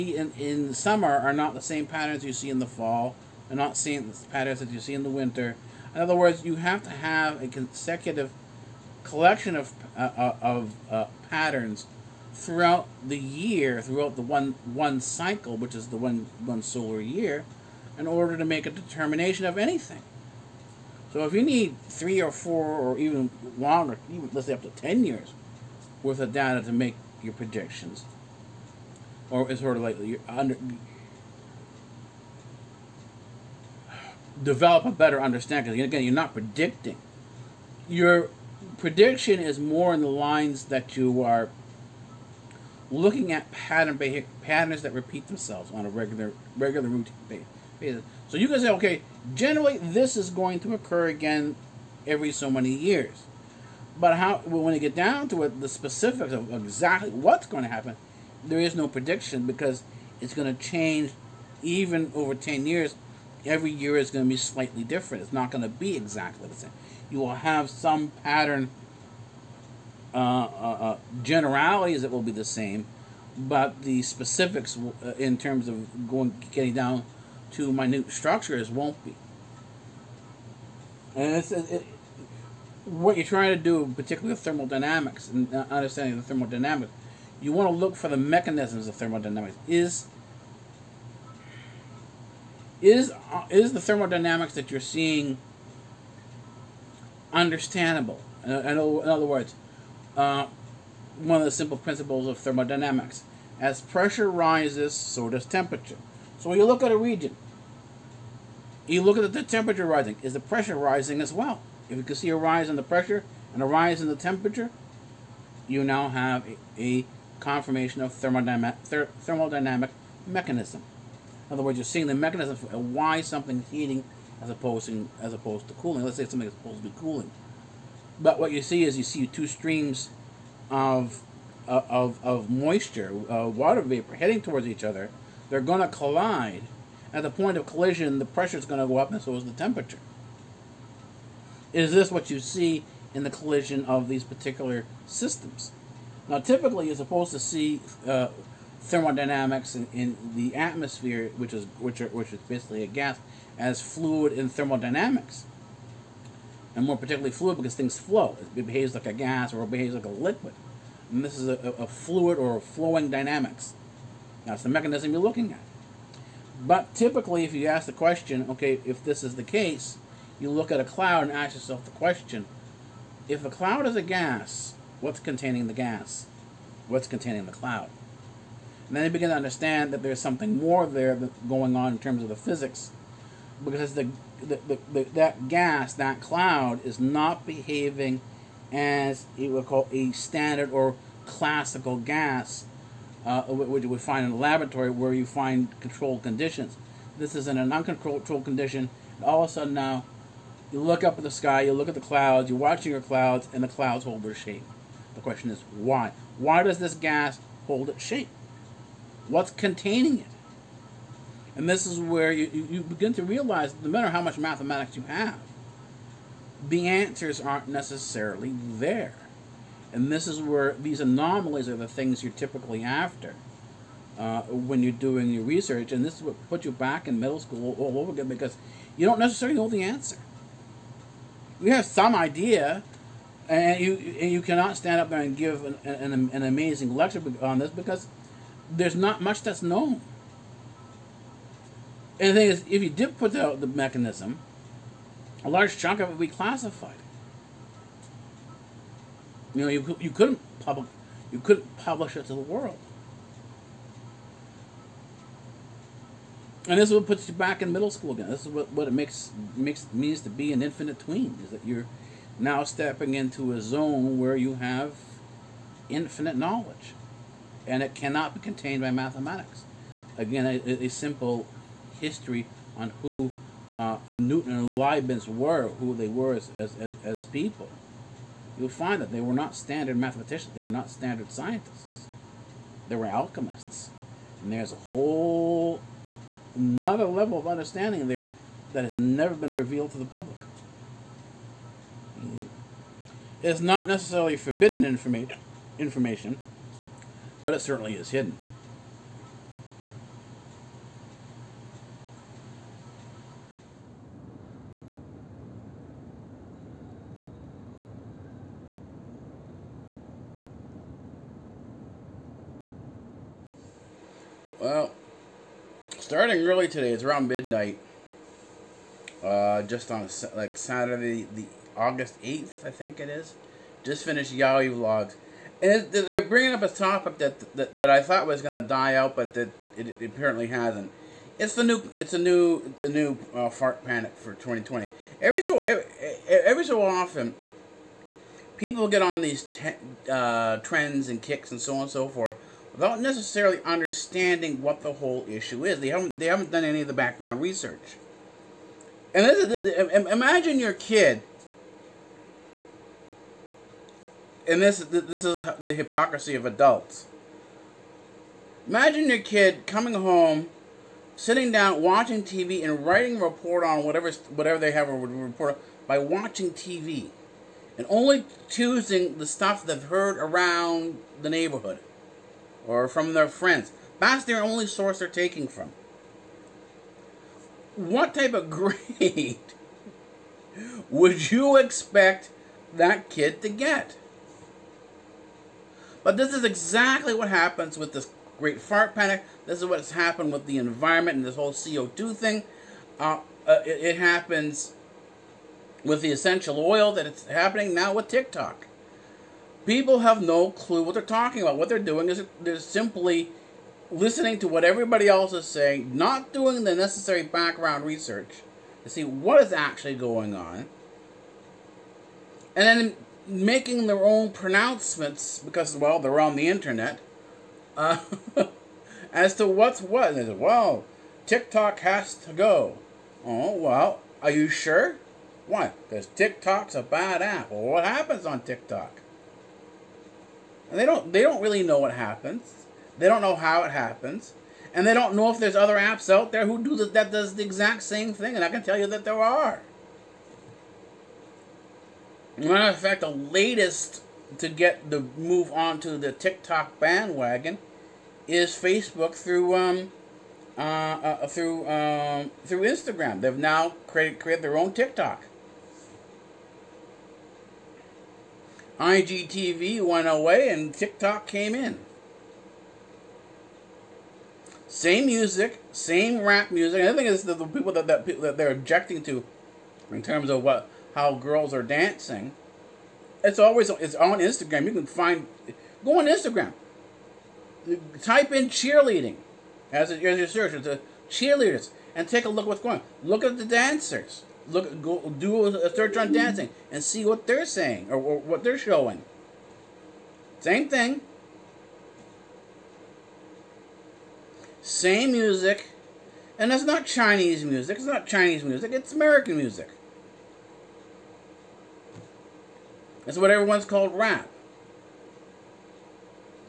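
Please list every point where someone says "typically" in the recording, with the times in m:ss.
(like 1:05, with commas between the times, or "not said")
2:26, 2:46, 3:42.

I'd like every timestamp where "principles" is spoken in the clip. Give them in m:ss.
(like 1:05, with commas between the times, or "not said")
1:41.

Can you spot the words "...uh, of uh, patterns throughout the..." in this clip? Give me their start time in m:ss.
0:10.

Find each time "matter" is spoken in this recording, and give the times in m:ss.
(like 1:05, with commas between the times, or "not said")
3:33, 7:22.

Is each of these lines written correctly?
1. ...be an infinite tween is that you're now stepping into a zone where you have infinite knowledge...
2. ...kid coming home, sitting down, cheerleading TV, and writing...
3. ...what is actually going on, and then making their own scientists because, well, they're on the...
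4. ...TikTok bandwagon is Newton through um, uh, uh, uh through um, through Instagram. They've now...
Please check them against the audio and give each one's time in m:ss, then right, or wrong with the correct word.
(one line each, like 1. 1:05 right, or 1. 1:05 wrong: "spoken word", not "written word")
1. 4:20 right
2. 5:59 wrong: "watching", not "cheerleading"
3. 6:49 wrong: "pronouncements", not "scientists"
4. 7:26 wrong: "Facebook", not "Newton".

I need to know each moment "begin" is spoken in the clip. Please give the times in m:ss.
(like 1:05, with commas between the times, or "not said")
2:59, 3:32.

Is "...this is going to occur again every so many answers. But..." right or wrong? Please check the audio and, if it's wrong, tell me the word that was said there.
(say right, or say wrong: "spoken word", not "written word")
wrong: "years", not "answers".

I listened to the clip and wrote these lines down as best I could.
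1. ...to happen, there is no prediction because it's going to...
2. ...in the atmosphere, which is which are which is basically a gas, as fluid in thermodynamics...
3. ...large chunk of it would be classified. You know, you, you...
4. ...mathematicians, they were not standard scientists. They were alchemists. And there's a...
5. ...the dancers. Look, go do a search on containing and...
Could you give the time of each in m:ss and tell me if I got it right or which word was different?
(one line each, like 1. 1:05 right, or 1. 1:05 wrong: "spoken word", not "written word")
1. 0:57 right
2. 2:29 right
3. 4:05 right
4. 4:39 right
5. 8:03 wrong: "dancing", not "containing".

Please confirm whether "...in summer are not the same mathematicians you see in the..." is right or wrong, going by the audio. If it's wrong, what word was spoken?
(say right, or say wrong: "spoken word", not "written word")
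wrong: "patterns", not "mathematicians".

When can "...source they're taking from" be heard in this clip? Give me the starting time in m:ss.
6:14.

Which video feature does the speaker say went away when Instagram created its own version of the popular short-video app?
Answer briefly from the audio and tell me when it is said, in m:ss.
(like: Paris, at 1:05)
IGTV, at 7:38.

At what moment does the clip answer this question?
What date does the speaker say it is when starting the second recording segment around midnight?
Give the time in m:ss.
5:21.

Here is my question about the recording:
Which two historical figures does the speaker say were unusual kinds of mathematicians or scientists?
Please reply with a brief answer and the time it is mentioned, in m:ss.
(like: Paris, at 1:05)
Newton and Leibniz, at 4:34.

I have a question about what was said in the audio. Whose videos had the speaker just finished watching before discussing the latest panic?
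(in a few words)
YAWI Vlogs.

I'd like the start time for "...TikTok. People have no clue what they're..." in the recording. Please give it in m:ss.
6:38.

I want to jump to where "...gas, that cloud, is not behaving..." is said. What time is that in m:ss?
3:05.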